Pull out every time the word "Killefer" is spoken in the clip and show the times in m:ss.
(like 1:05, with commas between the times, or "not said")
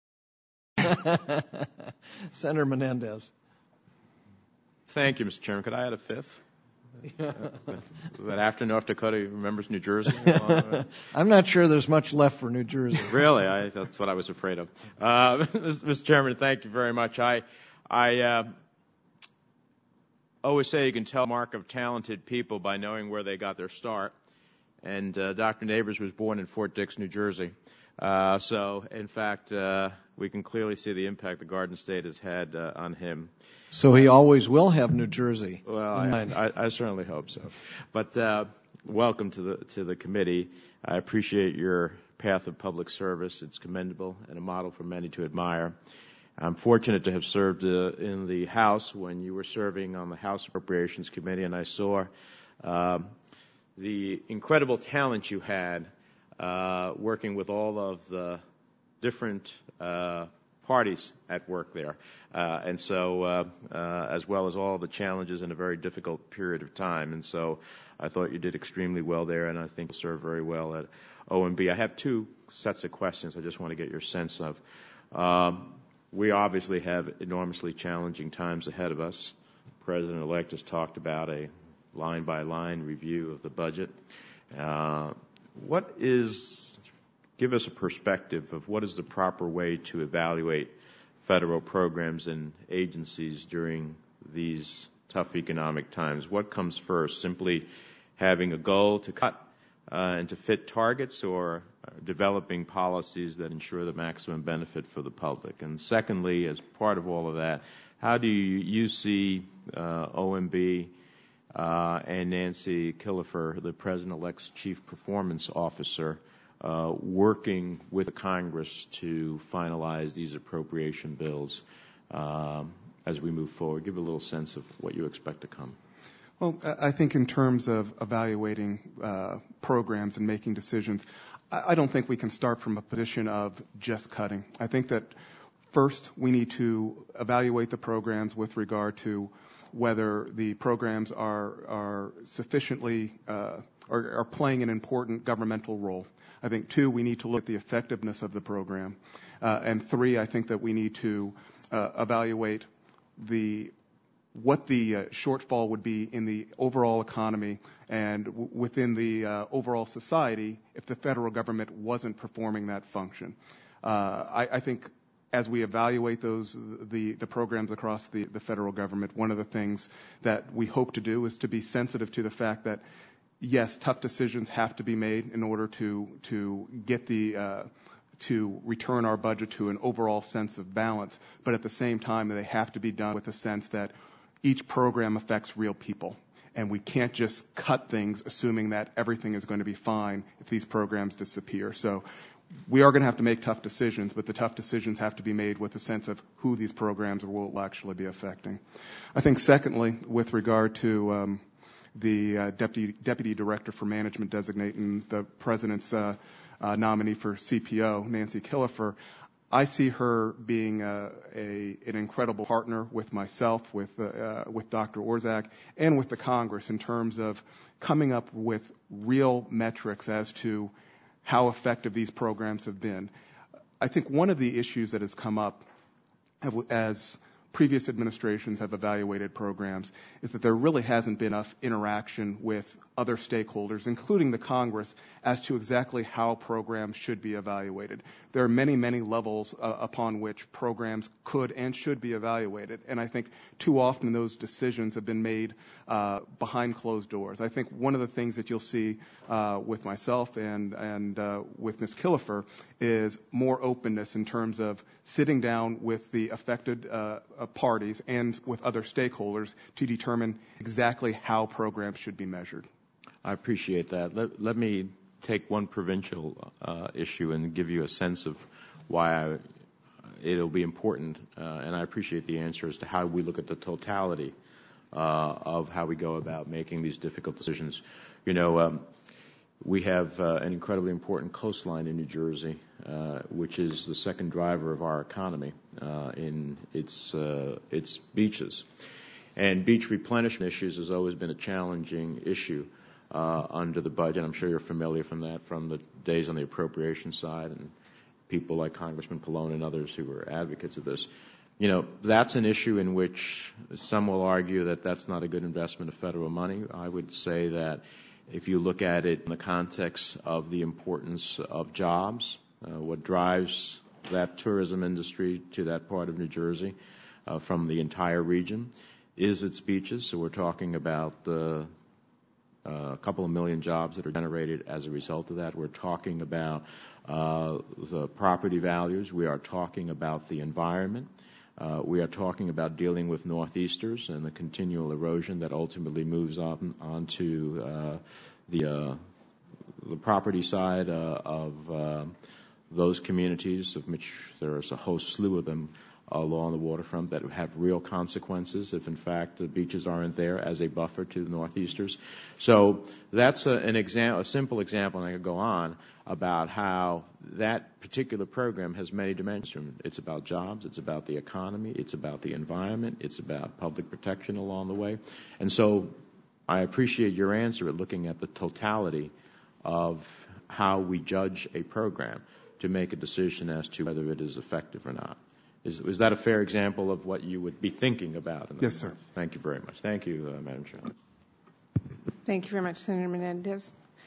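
1:52, 3:28, 4:11.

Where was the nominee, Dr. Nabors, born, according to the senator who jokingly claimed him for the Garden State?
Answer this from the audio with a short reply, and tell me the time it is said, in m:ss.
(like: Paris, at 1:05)
Fort Dix, New Jersey, at 0:26.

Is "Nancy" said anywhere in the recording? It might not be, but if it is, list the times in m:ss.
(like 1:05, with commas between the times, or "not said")
1:52, 3:28.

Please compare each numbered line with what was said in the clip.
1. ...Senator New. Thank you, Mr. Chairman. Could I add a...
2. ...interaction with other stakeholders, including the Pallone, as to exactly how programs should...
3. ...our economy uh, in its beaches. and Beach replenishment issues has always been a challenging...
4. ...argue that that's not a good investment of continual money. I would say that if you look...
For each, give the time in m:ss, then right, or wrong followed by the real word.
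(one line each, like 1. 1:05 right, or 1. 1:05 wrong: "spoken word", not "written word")
1. 0:02 wrong: "Menendez", not "New"
2. 3:51 wrong: "Congress", not "Pallone"
3. 4:44 right
4. 5:04 wrong: "federal", not "continual".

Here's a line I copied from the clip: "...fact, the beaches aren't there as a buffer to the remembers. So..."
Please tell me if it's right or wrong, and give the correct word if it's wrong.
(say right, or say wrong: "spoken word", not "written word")
wrong: "northeasters", not "remembers".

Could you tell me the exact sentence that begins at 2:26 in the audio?
I think, two, we need to look at the effectiveness of the program.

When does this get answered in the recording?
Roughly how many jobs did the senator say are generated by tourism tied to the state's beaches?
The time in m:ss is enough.
5:22.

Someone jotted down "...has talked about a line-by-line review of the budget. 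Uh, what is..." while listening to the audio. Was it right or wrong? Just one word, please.
right.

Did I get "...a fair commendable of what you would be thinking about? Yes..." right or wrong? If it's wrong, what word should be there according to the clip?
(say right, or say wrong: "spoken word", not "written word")
wrong: "example", not "commendable".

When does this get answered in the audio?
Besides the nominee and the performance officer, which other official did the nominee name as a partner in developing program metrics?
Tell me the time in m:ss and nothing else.
3:34.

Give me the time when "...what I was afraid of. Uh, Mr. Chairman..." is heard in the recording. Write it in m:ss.
0:13.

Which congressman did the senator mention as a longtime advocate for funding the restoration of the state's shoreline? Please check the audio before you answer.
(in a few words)
Congressman Pallone.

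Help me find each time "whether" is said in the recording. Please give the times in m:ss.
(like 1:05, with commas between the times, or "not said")
2:19, 6:13.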